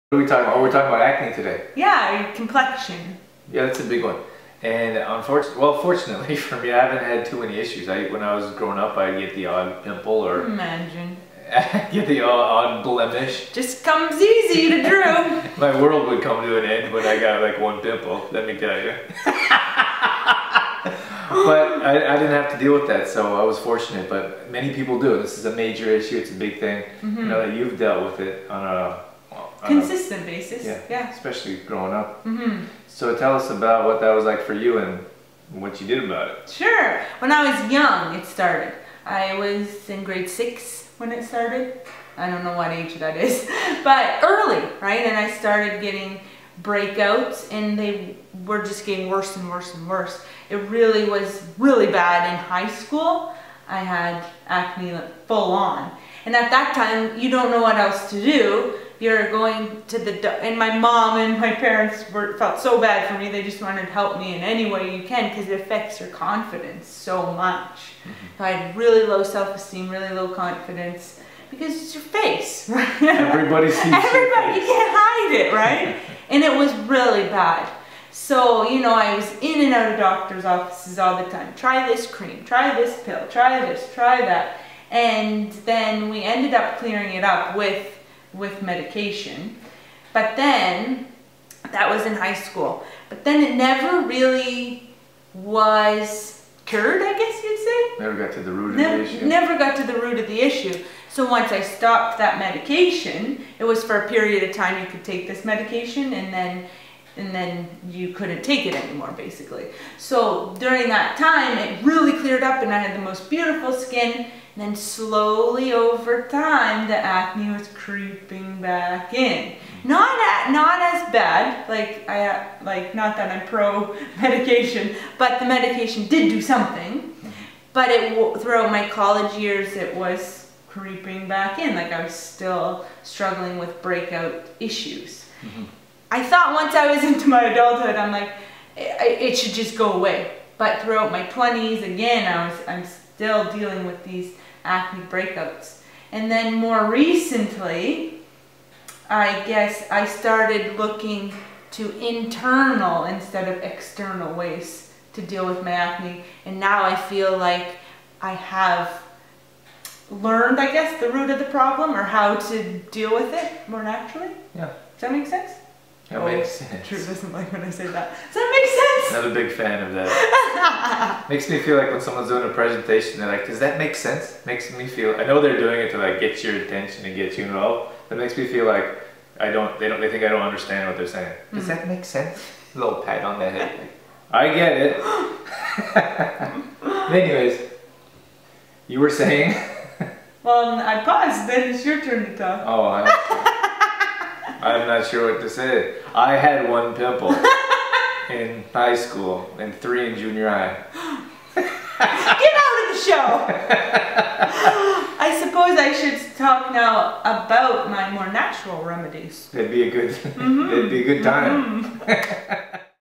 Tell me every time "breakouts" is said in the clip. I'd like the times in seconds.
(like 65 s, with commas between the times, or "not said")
46 s, 133 s, 145 s.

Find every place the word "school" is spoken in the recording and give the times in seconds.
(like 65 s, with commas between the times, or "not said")
52 s, 92 s, 198 s.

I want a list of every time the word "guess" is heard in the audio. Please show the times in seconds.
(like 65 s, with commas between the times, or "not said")
97 s, 149 s, 160 s.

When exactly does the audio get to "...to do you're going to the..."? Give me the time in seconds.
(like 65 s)
58 s.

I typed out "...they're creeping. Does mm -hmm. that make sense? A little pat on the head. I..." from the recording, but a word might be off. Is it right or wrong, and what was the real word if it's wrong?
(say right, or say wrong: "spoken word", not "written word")
wrong: "saying", not "creeping".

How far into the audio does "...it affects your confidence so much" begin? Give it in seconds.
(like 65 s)
65 s.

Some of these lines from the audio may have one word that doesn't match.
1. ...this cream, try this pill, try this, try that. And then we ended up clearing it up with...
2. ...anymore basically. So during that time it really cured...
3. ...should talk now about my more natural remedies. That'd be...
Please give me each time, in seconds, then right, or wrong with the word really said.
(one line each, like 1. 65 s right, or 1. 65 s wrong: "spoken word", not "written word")
1. 81 s right
2. 108 s wrong: "cleared", not "cured"
3. 205 s right.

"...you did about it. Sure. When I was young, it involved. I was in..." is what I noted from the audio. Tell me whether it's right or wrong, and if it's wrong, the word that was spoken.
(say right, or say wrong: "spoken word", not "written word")
wrong: "started", not "involved".